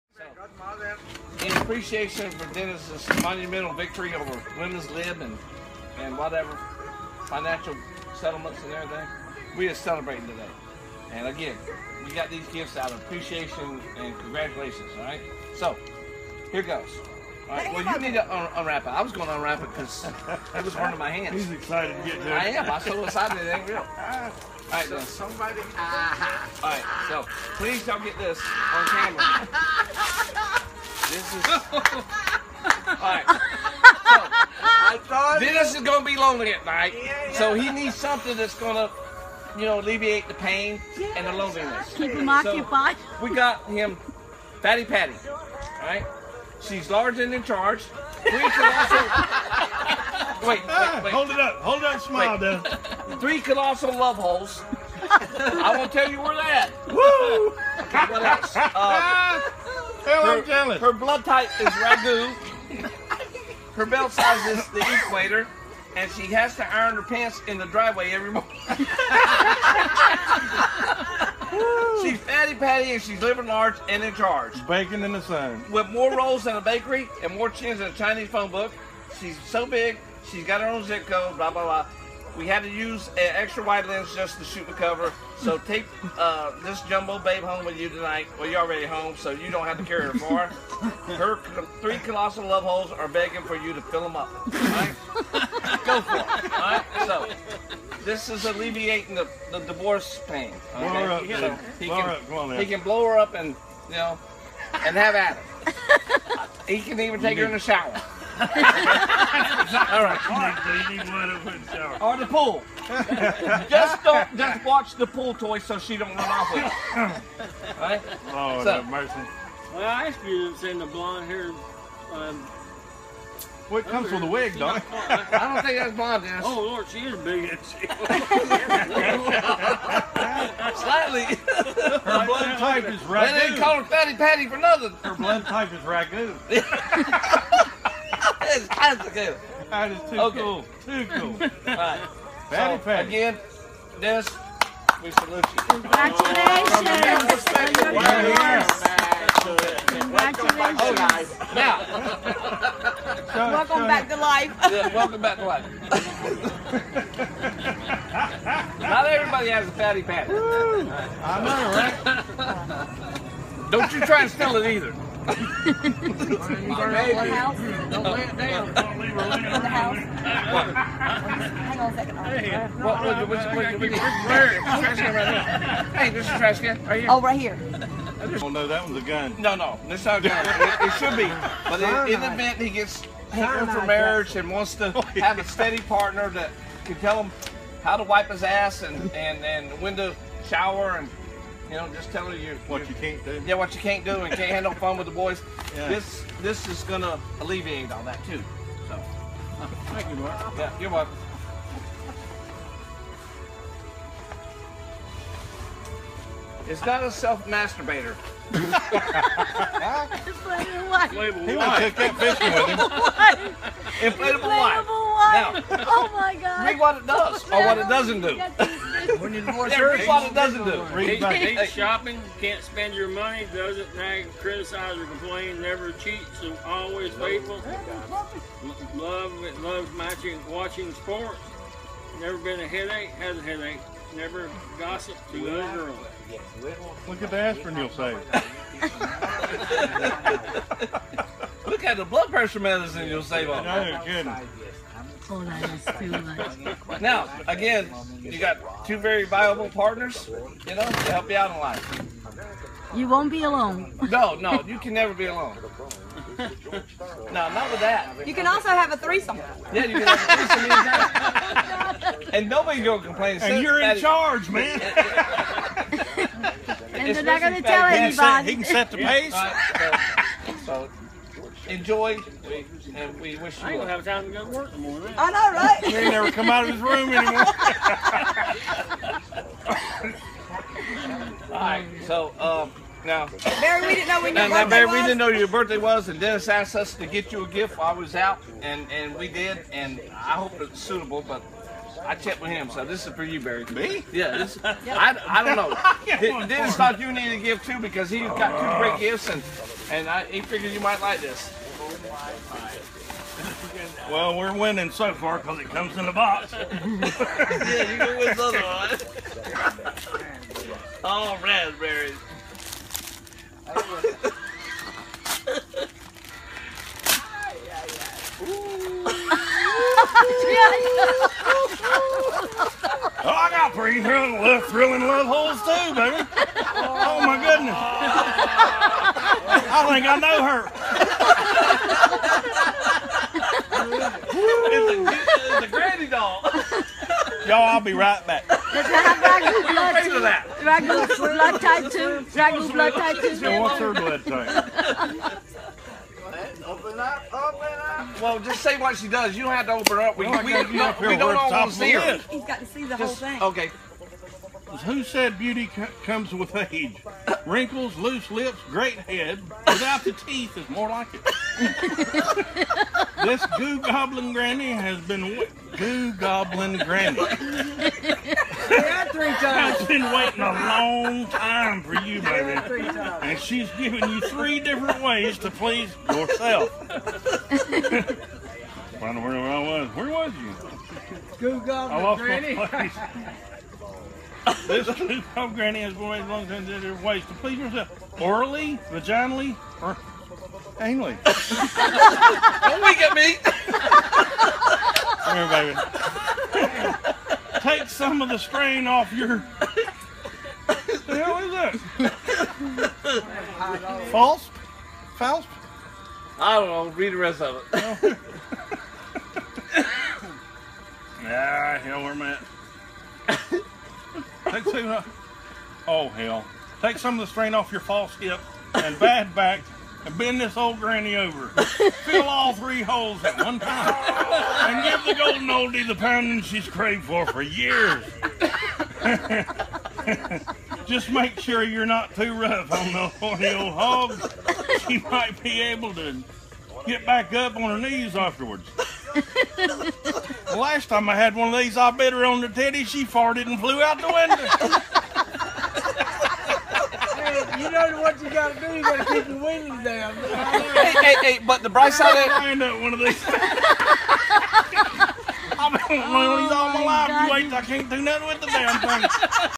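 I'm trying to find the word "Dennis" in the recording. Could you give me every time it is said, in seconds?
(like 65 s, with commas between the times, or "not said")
2 s, 144 s, 286 s, 296 s.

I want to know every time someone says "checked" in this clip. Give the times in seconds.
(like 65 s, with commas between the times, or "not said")
292 s.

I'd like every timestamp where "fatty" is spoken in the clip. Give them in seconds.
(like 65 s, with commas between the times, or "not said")
44 s, 72 s, 133 s, 159 s.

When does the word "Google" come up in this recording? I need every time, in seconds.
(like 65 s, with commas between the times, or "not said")
381 s.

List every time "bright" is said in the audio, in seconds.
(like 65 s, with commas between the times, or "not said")
451 s.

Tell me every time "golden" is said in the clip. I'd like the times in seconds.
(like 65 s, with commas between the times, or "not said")
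425 s.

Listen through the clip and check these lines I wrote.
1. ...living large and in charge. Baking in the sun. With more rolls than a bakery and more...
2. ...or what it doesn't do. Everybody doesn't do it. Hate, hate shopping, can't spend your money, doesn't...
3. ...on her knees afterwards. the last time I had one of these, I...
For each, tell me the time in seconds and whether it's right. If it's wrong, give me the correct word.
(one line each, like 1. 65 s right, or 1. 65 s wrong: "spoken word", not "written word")
1. 73 s right
2. 217 s right
3. 437 s right.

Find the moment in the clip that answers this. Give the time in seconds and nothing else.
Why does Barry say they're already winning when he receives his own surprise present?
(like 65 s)
305 s.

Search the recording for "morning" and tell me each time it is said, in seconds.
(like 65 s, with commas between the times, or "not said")
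68 s, 274 s.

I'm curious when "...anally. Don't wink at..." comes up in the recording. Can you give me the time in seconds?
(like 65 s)
390 s.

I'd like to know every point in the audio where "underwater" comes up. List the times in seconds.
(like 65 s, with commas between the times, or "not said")
not said.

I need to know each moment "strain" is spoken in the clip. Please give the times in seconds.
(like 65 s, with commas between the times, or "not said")
398 s, 417 s.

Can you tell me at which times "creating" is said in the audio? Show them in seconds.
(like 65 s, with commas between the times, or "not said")
not said.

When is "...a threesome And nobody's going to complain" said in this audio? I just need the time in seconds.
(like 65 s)
262 s.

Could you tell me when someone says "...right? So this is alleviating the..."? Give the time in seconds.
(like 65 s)
96 s.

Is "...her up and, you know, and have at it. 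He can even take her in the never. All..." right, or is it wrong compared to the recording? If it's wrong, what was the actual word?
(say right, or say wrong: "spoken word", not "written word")
wrong: "shower", not "never".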